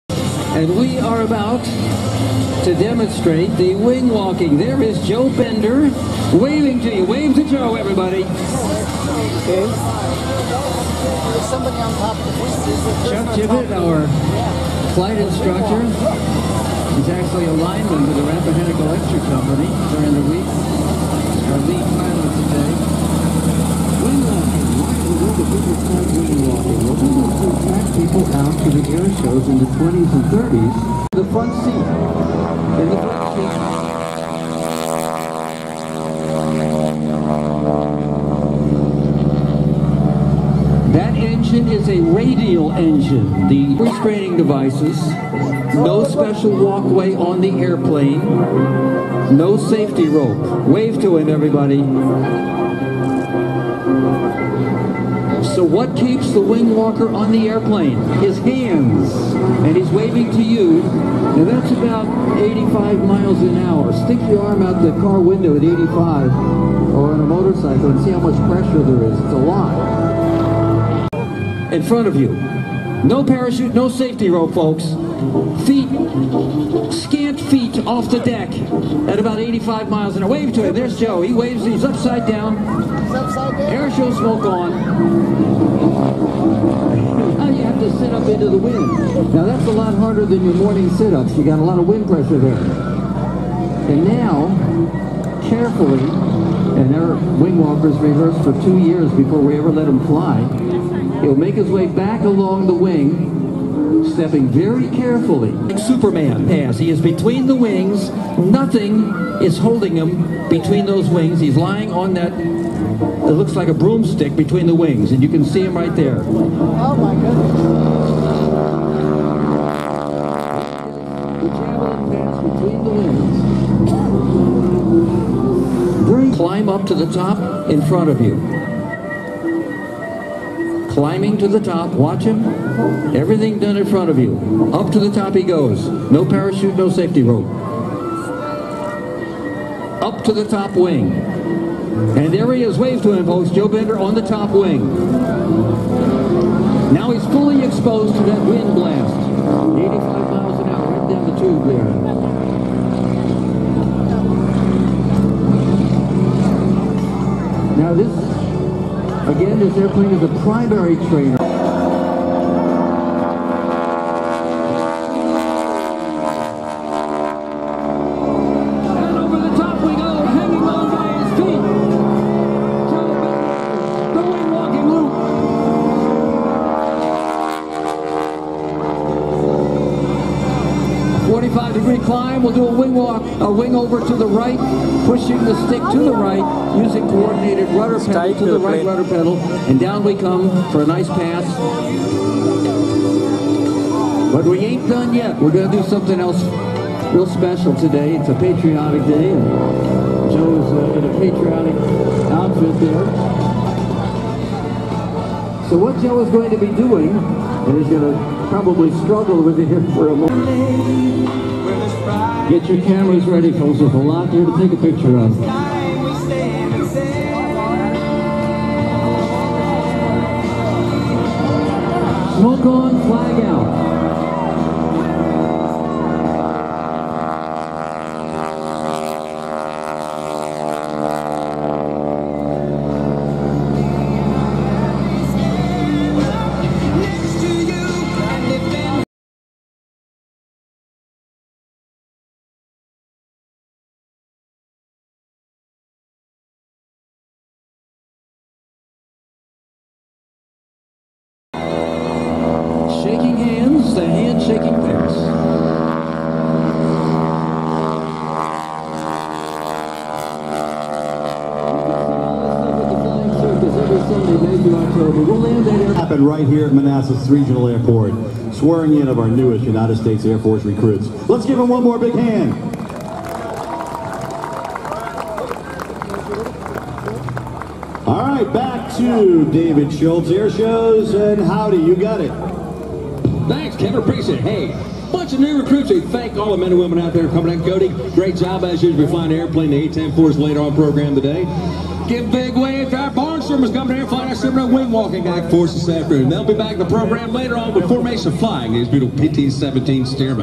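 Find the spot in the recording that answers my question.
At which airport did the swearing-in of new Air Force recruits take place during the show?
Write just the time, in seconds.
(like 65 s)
266 s.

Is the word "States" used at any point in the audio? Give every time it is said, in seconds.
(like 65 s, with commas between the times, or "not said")
269 s.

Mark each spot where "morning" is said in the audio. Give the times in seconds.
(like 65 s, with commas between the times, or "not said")
90 s.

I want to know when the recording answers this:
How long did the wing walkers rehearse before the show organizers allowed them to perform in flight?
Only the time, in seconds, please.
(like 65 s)
98 s.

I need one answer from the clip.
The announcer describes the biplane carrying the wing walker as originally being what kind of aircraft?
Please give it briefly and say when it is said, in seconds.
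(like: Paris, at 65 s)
primary trainer, at 160 s.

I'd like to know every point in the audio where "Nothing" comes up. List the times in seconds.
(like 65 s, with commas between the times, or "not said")
108 s.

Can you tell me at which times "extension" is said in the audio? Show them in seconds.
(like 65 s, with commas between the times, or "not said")
not said.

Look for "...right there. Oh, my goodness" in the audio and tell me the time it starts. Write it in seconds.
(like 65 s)
115 s.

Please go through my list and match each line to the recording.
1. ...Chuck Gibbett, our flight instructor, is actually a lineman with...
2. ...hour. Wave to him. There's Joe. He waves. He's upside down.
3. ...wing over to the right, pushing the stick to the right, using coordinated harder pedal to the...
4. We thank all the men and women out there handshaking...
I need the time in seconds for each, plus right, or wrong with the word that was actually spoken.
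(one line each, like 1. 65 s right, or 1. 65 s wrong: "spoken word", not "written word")
1. 13 s right
2. 80 s right
3. 183 s wrong: "rudder", not "harder"
4. 285 s wrong: "coming", not "handshaking".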